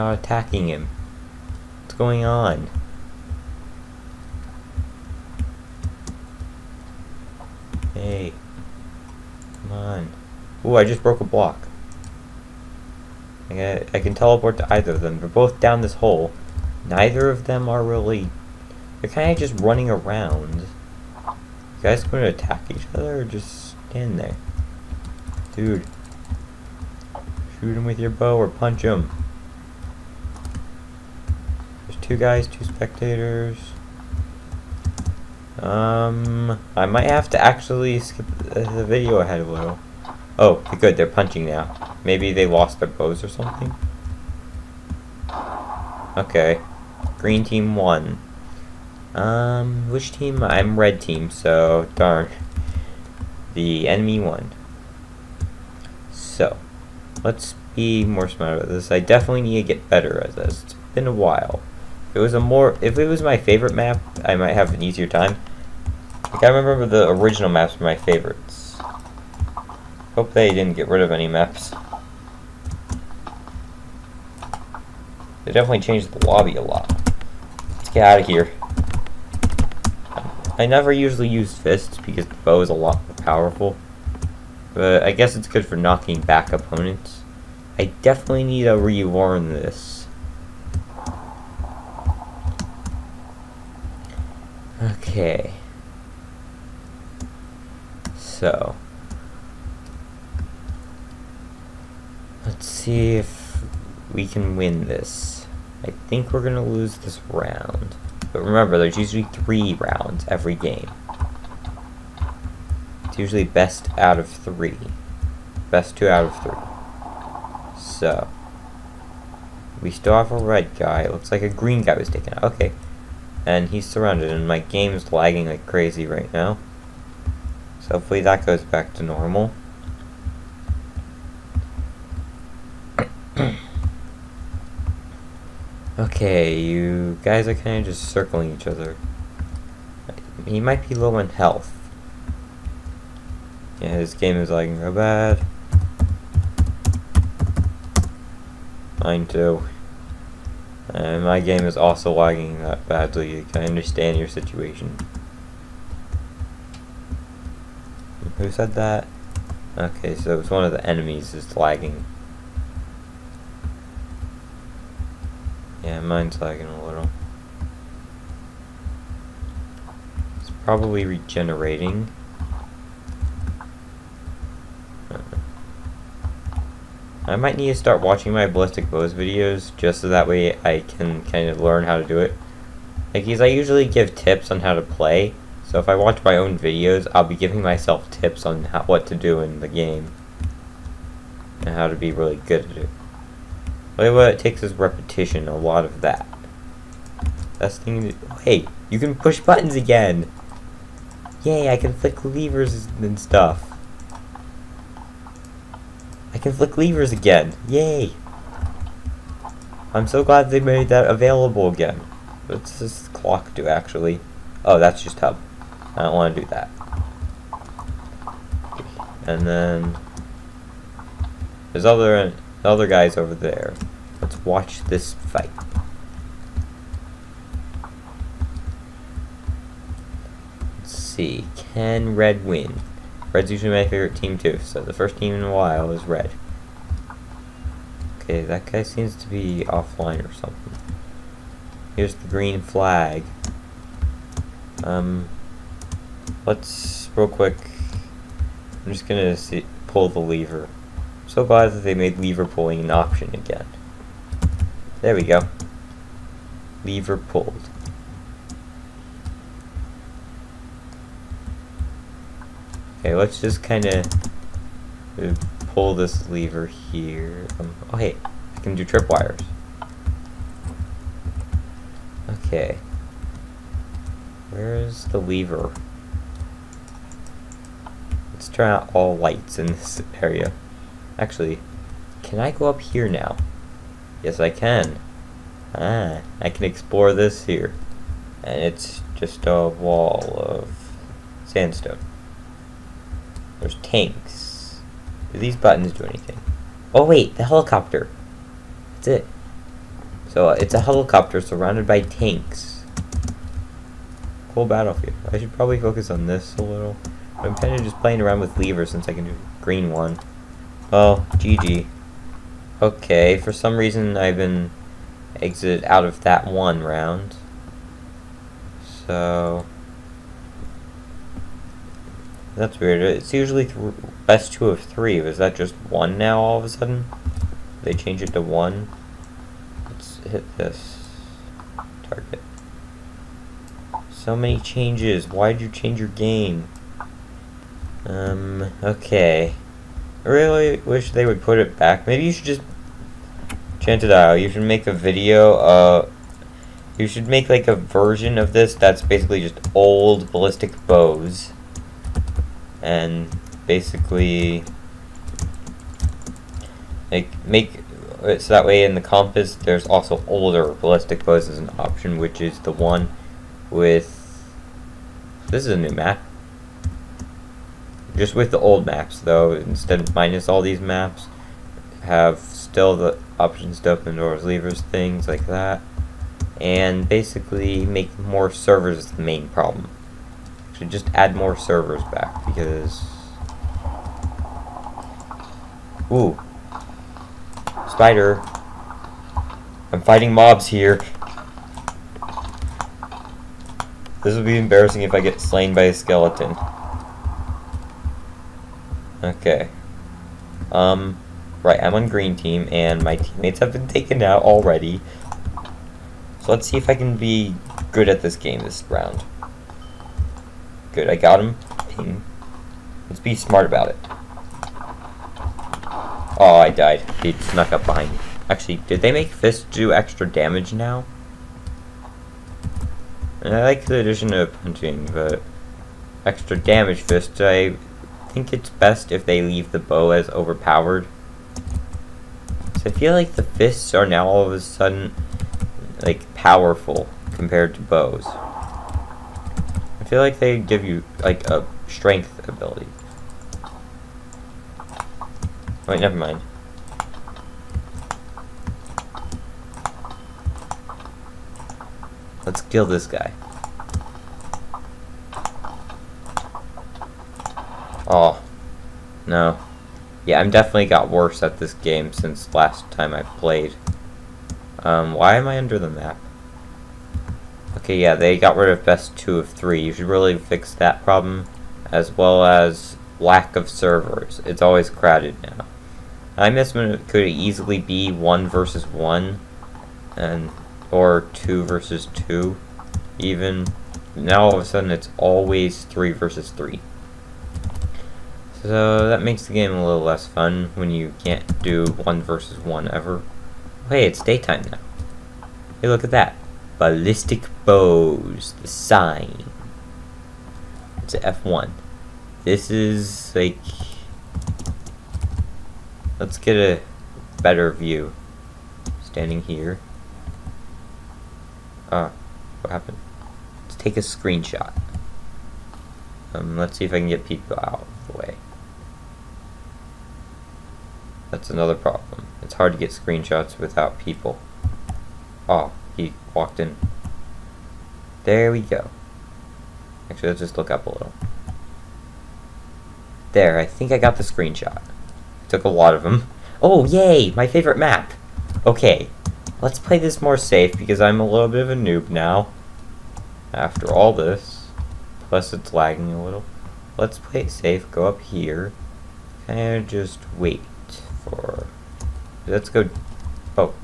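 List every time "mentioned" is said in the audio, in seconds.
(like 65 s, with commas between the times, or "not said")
not said.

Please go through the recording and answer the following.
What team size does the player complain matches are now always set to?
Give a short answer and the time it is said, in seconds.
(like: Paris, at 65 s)
3 versus 3, at 485 s.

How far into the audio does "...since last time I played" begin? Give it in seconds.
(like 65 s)
462 s.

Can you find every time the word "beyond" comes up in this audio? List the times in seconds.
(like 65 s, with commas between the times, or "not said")
not said.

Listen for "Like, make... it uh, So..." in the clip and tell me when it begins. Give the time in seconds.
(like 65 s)
357 s.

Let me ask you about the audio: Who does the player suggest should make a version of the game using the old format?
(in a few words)
Enchanted Isle.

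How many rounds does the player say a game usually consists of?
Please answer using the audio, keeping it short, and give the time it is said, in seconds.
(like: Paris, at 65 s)
3, at 109 s.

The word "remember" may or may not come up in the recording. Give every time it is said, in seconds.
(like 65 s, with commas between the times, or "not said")
66 s, 108 s.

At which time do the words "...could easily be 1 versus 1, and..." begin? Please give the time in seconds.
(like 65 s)
477 s.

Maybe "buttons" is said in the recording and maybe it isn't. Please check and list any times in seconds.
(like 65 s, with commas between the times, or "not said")
199 s, 295 s.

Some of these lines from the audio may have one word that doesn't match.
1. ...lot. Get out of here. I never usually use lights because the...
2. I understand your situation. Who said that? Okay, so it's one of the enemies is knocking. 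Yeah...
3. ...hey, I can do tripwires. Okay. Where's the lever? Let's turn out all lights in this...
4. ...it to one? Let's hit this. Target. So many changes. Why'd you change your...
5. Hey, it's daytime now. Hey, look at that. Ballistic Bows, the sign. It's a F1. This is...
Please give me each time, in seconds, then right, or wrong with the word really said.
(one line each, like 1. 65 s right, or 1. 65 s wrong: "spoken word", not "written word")
1. 76 s wrong: "fists", not "lights"
2. 153 s wrong: "lagging", not "knocking"
3. 267 s right
4. 328 s right
5. 493 s right.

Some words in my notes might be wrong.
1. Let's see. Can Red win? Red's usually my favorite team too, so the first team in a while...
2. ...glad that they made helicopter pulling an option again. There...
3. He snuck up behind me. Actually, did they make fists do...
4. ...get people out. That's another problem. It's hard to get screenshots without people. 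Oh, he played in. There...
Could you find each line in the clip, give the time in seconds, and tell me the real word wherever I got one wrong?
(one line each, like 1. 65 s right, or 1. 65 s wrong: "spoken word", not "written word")
1. 230 s right
2. 251 s wrong: "lever", not "helicopter"
3. 417 s right
4. 517 s wrong: "walked", not "played".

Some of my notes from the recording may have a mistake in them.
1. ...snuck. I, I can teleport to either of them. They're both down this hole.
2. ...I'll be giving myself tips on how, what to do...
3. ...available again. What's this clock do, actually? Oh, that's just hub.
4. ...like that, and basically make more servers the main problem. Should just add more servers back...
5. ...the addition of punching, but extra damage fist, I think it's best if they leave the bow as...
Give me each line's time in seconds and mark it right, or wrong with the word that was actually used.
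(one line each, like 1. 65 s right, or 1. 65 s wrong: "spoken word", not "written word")
1. 11 s wrong: "block", not "snuck"
2. 187 s right
3. 211 s right
4. 375 s right
5. 423 s right.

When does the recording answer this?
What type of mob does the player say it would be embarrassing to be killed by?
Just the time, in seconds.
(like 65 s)
395 s.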